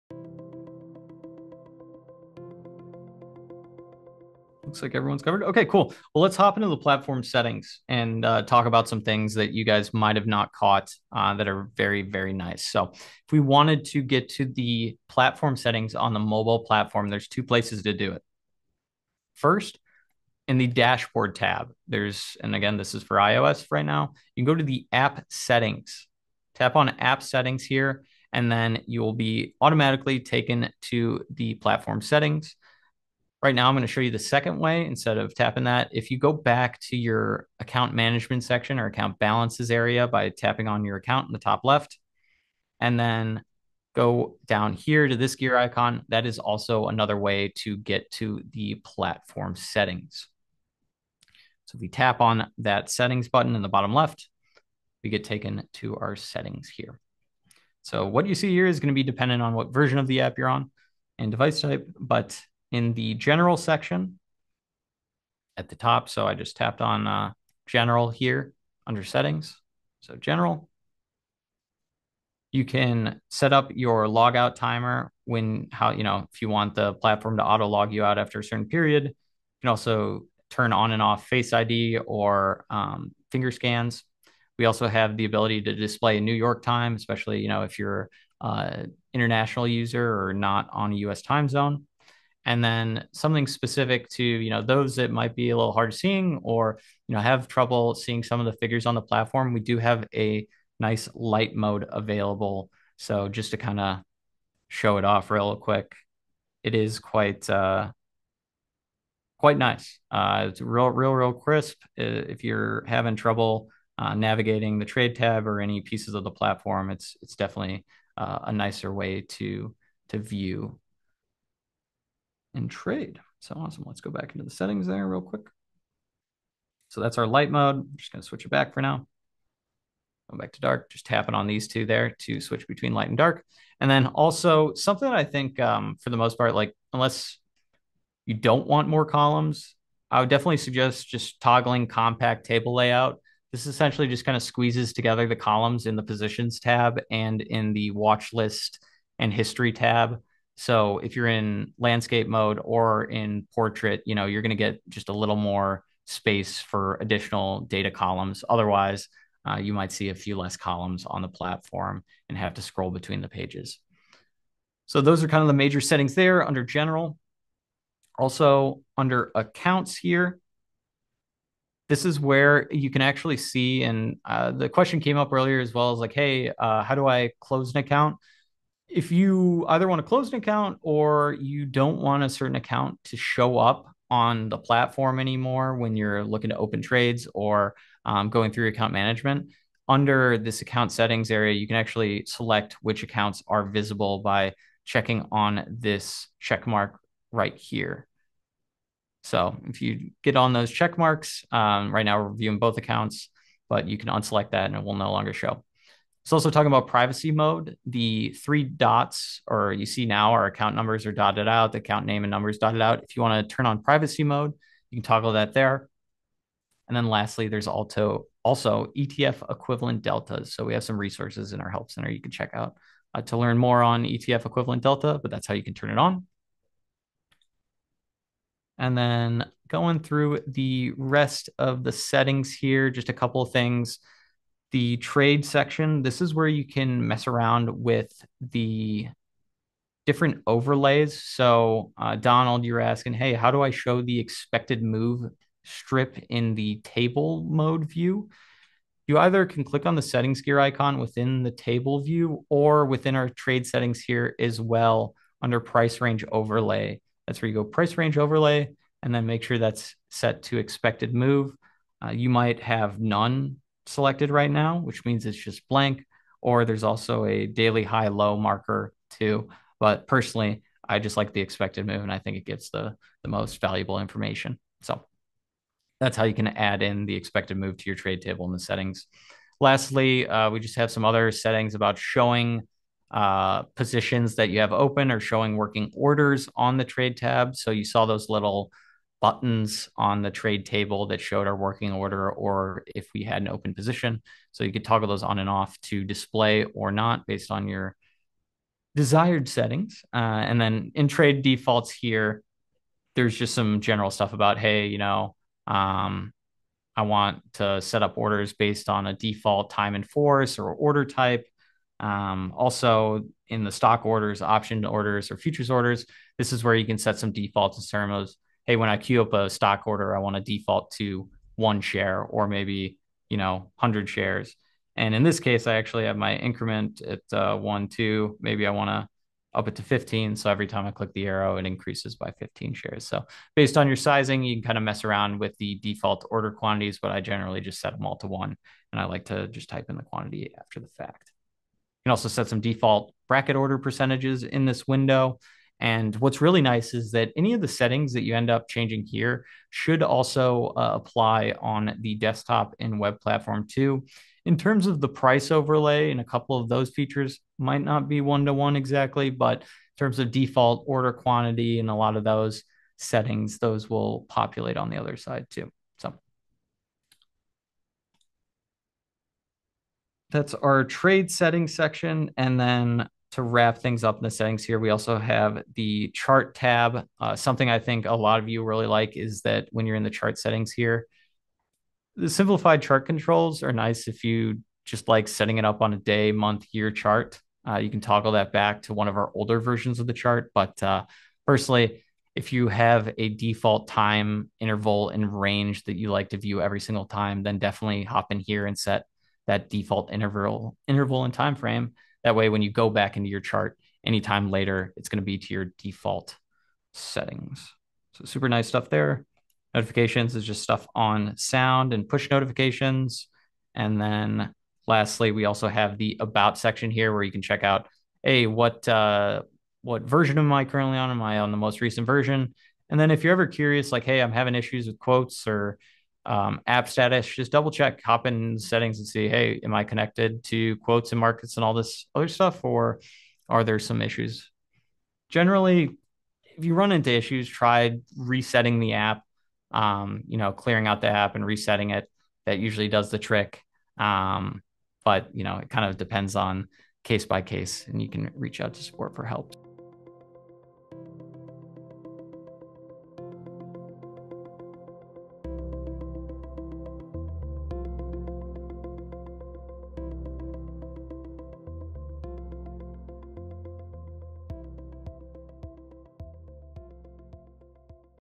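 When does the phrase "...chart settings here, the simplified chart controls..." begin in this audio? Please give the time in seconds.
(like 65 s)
380 s.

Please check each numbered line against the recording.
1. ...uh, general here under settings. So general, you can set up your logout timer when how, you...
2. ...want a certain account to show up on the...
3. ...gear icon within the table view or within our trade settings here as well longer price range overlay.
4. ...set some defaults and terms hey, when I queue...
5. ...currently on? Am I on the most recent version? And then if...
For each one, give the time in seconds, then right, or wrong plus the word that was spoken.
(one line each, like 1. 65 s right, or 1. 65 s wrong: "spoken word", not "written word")
1. 67 s right
2. 181 s right
3. 250 s wrong: "under", not "longer"
4. 316 s right
5. 420 s right.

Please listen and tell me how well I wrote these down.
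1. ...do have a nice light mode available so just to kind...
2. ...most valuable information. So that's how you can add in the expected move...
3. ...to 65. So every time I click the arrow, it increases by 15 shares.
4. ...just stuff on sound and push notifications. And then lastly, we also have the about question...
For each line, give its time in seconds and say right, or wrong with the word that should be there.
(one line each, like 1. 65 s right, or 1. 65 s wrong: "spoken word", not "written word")
1. 99 s right
2. 273 s right
3. 329 s wrong: "15", not "65"
4. 410 s wrong: "section", not "question".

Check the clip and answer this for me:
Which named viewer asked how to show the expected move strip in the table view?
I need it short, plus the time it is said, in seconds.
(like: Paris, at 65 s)
Donald, at 242 s.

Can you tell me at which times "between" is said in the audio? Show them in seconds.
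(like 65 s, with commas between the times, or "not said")
132 s, 162 s.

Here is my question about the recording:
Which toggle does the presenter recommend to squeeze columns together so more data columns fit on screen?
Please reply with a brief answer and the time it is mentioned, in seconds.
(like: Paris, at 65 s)
compact table layout, at 141 s.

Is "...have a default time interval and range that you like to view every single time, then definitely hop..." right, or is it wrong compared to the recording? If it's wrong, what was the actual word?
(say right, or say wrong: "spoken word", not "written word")
right.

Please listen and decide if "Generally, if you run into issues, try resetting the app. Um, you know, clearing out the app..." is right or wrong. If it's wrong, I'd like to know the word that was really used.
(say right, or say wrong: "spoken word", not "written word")
right.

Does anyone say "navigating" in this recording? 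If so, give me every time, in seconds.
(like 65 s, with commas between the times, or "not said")
114 s.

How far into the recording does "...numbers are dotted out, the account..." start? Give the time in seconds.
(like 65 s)
210 s.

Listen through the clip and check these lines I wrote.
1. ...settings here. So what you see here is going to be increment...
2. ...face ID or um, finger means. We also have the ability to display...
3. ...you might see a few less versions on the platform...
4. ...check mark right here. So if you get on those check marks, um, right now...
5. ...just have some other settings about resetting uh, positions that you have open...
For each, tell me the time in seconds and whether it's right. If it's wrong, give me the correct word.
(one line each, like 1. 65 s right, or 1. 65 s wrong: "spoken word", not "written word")
1. 56 s wrong: "dependent", not "increment"
2. 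81 s wrong: "scans", not "means"
3. 159 s wrong: "columns", not "versions"
4. 196 s right
5. 280 s wrong: "showing", not "resetting".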